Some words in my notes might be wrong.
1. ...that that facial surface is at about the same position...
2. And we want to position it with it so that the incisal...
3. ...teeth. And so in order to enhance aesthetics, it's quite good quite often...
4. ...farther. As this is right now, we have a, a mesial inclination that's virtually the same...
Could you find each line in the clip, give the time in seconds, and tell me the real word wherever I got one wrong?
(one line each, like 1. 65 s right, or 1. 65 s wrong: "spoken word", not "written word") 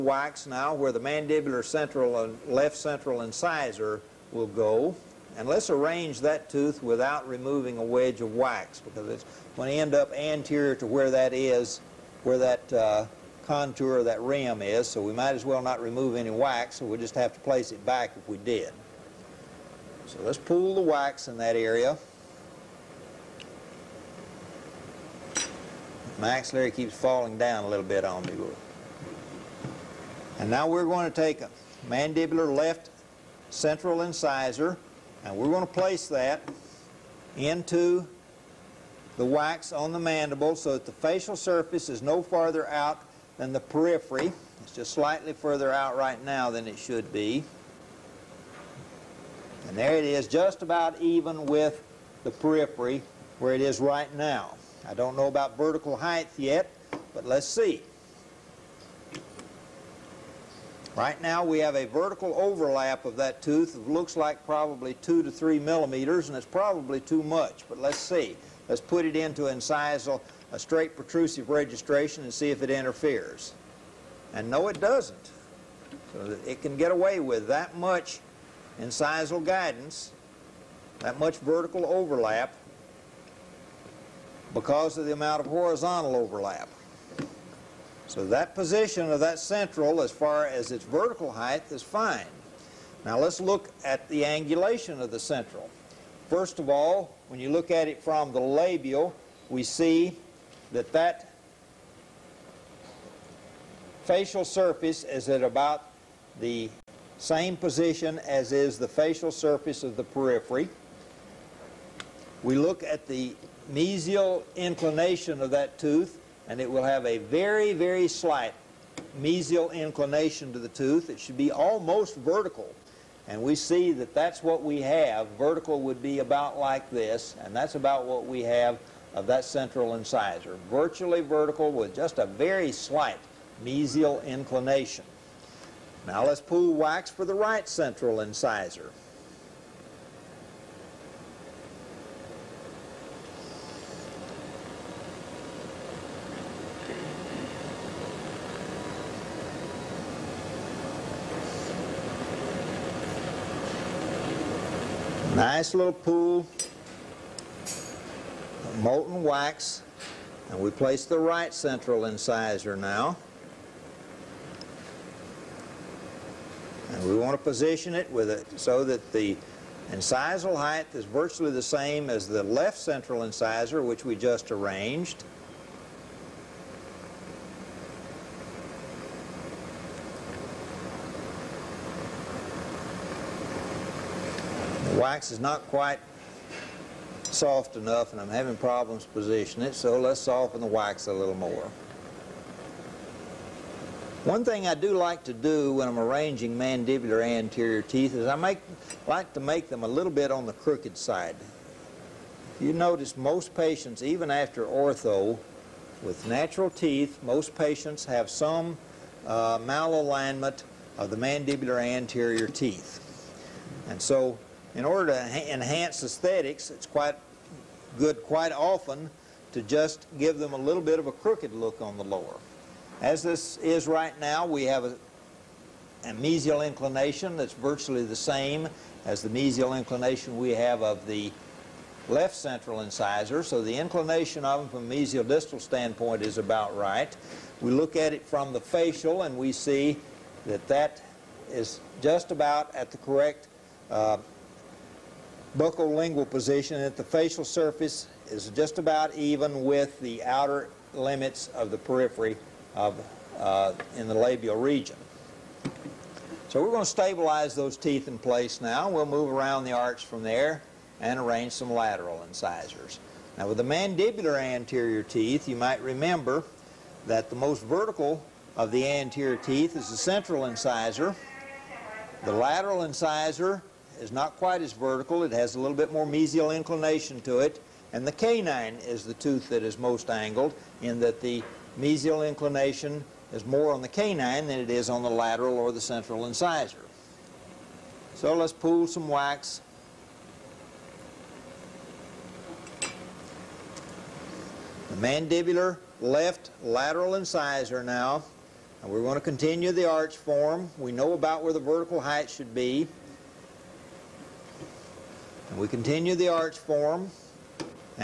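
1. 100 s right
2. 166 s right
3. 212 s right
4. 222 s wrong: "lower", not "farther".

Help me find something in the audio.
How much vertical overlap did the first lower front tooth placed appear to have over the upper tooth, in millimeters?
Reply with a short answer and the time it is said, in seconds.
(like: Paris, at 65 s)
2 to 3 millimeters, at 65 s.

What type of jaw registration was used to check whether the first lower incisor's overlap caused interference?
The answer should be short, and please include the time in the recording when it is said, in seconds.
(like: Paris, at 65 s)
straight protrusive, at 70 s.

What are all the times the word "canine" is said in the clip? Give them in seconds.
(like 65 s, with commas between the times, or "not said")
278 s, 283 s.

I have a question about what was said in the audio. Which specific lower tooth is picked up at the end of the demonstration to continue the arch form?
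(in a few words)
mandibular left lateral incisor.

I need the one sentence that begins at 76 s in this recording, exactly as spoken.
So it can get away with that much incisal guidance, that much vertical overlap, because of the amount of horizontal overlap.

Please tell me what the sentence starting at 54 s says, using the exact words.
I don't know about vertical height yet, but let's see.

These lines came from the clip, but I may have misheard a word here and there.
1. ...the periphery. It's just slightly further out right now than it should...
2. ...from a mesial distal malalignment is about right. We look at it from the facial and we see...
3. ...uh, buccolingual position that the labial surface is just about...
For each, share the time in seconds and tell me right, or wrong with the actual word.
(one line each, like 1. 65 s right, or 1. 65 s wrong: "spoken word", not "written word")
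1. 43 s right
2. 234 s wrong: "standpoint", not "malalignment"
3. 243 s wrong: "facial", not "labial".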